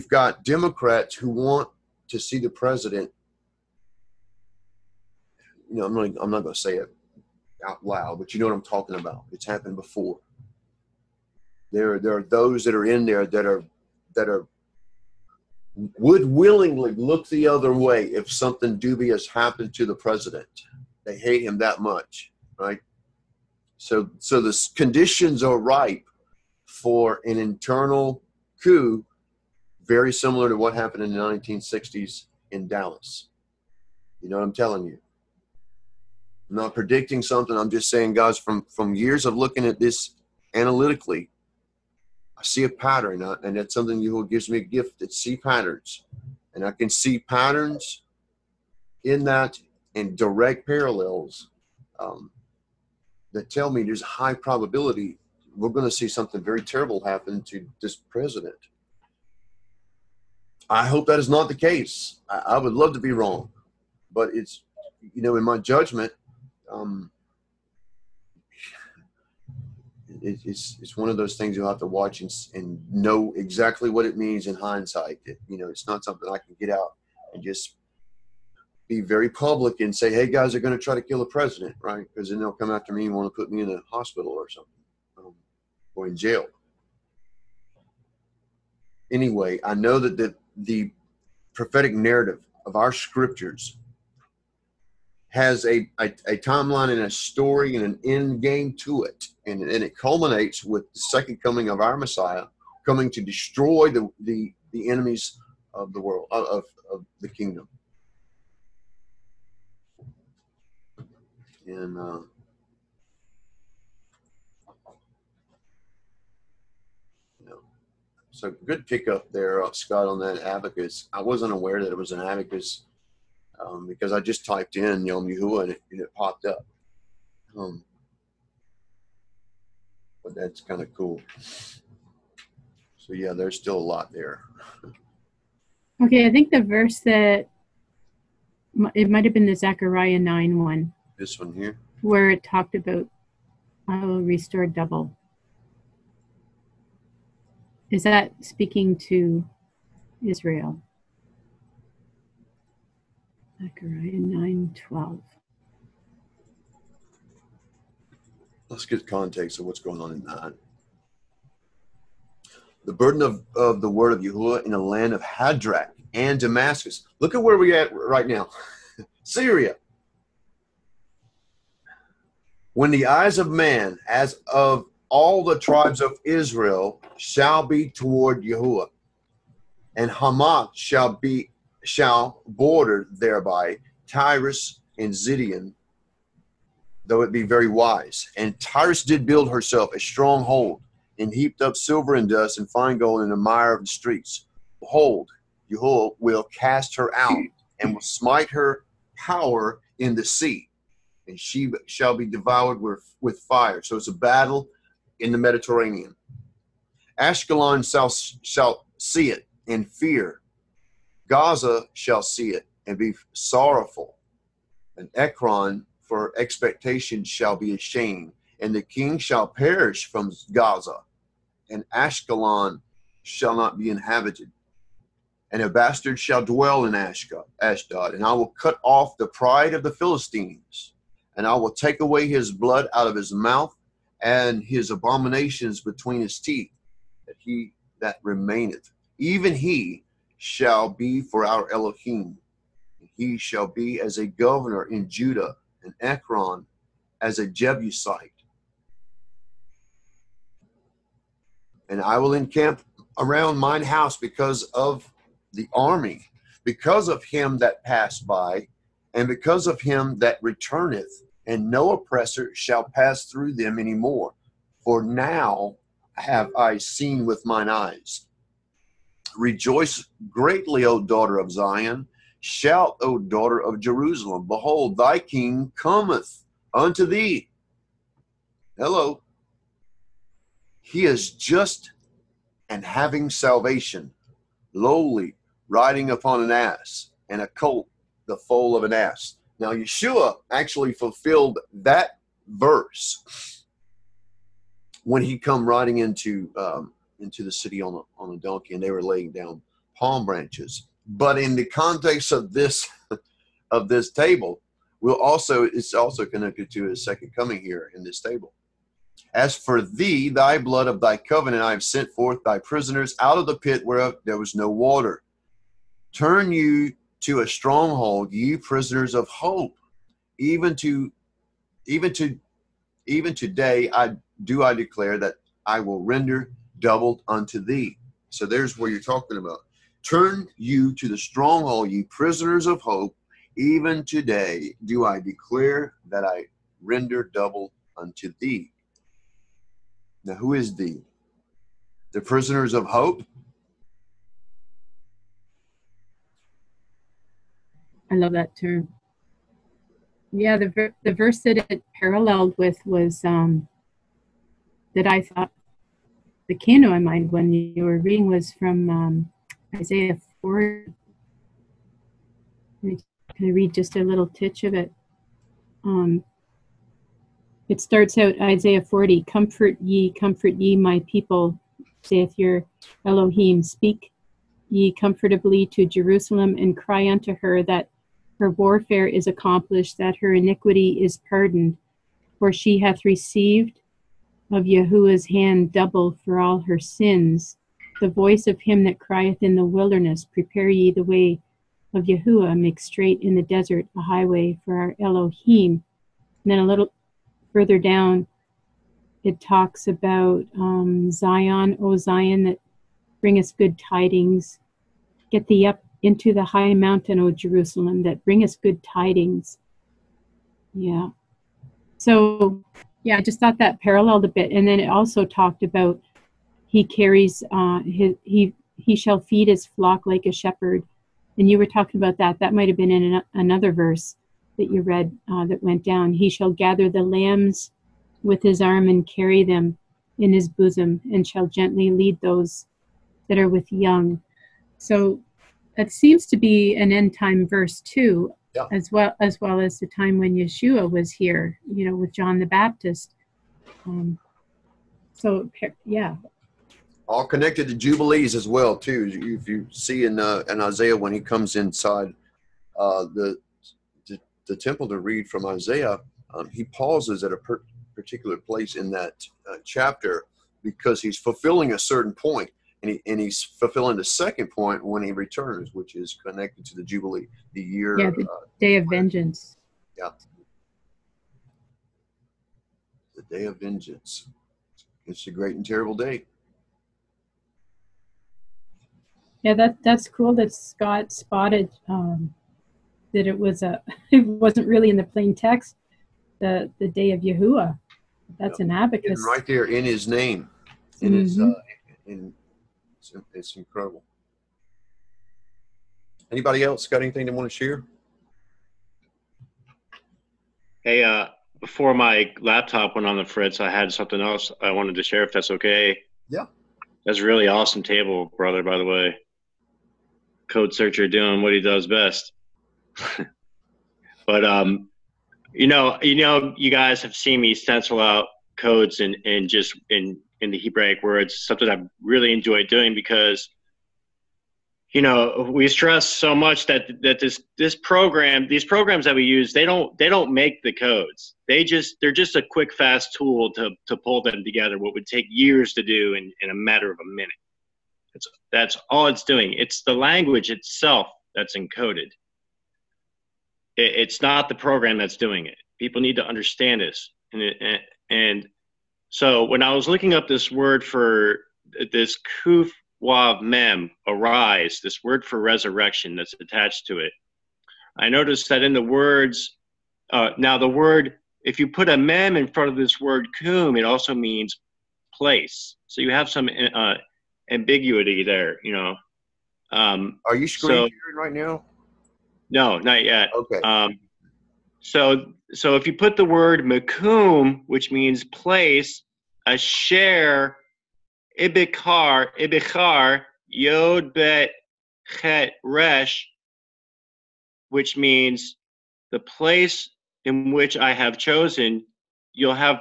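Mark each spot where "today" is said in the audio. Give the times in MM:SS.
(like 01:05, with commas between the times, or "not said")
05:23, 05:34.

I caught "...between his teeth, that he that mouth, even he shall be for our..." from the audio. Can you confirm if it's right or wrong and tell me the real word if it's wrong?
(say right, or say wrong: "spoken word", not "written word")
wrong: "remaineth", not "mouth".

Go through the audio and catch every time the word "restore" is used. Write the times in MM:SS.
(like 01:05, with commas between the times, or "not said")
02:24.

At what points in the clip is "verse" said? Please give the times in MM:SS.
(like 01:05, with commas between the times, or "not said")
02:16, 04:52, 05:51, 07:03, 07:17.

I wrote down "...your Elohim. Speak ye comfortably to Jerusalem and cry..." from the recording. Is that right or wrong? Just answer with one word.
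right.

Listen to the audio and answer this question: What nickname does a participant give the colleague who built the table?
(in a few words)
Code searcher.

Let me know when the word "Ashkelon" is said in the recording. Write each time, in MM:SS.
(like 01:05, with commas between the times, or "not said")
03:27, 03:41.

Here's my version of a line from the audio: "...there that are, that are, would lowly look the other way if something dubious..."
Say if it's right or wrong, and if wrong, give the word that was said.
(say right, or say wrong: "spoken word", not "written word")
wrong: "willingly", not "lowly".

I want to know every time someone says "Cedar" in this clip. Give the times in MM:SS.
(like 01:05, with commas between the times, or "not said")
not said.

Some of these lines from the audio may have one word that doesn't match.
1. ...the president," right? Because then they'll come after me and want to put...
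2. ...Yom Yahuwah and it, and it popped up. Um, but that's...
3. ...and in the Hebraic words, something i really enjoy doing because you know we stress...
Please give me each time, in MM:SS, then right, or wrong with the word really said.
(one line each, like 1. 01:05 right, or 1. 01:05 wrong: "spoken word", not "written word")
1. 01:21 right
2. 02:05 right
3. 08:39 right.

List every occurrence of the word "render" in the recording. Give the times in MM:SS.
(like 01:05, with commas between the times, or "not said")
05:26, 05:36.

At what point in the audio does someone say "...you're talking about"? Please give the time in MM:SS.
05:28.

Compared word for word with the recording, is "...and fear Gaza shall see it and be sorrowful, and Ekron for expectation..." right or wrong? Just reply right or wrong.
right.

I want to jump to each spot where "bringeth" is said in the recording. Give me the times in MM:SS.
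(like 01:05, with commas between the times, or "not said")
06:43, 06:48.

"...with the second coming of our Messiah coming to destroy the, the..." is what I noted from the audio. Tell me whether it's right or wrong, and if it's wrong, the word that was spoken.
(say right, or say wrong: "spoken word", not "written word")
right.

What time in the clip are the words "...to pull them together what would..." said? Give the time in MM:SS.
08:53.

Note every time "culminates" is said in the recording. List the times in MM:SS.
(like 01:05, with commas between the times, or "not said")
01:39.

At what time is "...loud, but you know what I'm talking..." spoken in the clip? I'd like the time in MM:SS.
00:07.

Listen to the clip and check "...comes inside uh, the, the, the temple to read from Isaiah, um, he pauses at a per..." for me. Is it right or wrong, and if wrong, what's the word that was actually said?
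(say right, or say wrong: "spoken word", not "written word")
right.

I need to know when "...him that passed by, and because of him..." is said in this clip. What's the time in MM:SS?
04:17.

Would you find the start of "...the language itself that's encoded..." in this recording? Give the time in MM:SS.
08:59.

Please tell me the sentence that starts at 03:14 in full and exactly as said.
Behold, Jehovah will cast her out, and will smite her power in the sea, and she shall be devoured with, with fire.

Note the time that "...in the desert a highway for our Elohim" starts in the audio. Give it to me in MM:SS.
06:33.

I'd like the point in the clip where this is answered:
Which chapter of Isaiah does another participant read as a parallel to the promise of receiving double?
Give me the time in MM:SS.
06:08.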